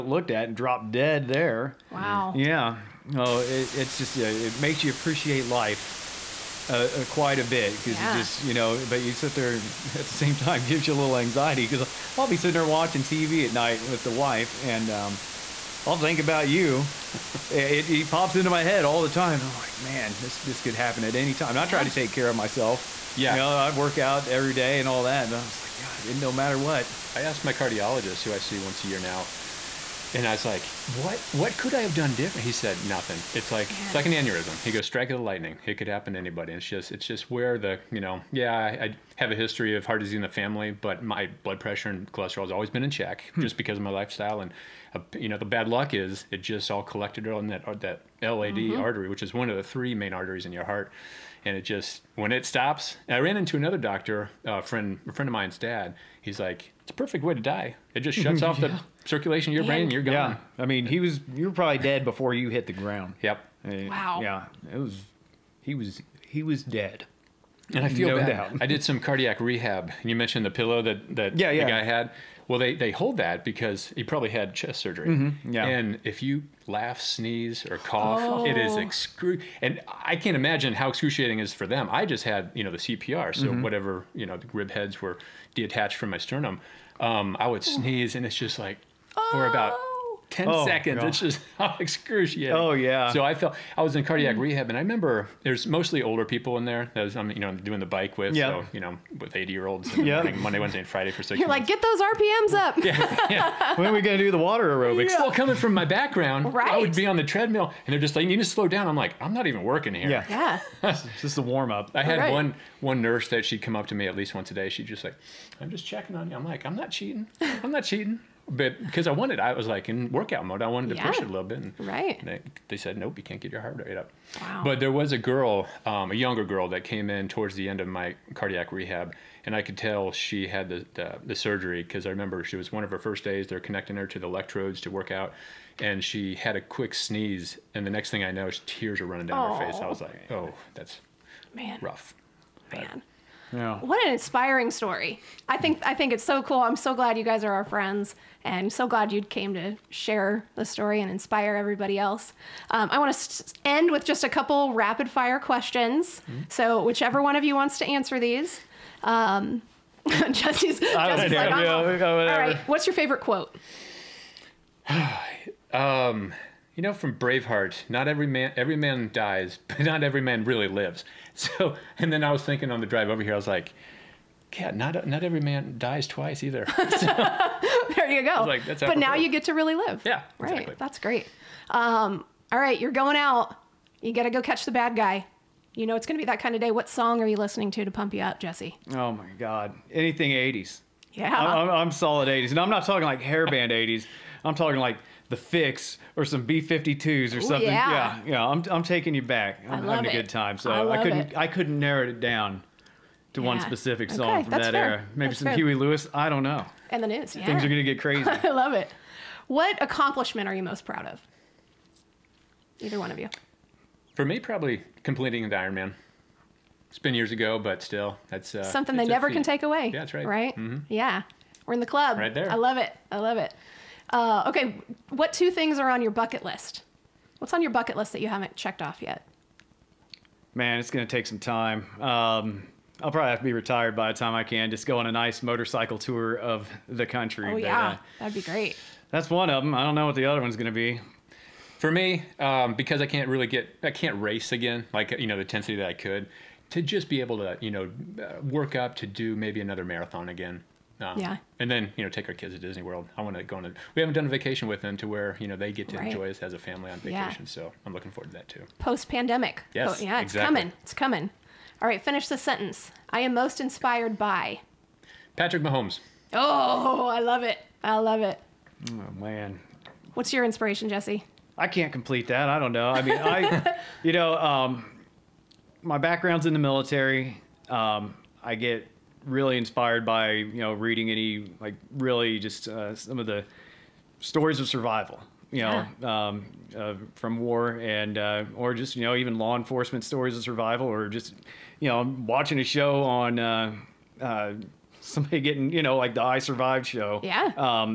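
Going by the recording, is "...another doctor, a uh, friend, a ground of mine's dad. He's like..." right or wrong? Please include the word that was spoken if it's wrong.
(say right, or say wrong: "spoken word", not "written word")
wrong: "friend", not "ground".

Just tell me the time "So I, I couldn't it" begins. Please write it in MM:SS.
03:20.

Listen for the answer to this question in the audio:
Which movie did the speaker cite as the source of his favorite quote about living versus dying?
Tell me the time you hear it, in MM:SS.
02:47.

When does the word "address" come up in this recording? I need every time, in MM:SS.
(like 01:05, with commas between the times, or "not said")
not said.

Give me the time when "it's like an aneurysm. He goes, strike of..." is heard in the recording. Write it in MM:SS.
00:33.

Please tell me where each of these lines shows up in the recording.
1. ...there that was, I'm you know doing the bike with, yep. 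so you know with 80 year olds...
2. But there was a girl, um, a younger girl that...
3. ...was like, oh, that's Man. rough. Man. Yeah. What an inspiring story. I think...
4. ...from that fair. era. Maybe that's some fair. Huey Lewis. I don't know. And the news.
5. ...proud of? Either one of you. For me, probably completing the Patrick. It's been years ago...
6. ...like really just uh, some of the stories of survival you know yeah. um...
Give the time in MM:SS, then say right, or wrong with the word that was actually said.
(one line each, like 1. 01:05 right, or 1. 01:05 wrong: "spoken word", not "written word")
1. 01:36 right
2. 02:04 right
3. 02:19 right
4. 03:24 right
5. 03:30 wrong: "Ironman", not "Patrick"
6. 04:41 right.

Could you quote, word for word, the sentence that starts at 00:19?
And I'm like, man, this this could happen at any time.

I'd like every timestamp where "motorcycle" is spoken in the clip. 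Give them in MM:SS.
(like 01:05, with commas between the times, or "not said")
03:55.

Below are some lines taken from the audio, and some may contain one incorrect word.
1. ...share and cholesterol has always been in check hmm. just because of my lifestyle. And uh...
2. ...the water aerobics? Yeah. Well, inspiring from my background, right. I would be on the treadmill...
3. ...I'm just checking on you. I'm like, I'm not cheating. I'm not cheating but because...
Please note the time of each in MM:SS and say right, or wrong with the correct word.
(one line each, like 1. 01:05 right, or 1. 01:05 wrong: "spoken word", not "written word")
1. 00:41 wrong: "pressure", not "share"
2. 01:44 wrong: "coming", not "inspiring"
3. 01:55 right.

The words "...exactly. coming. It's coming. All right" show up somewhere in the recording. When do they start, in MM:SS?
04:20.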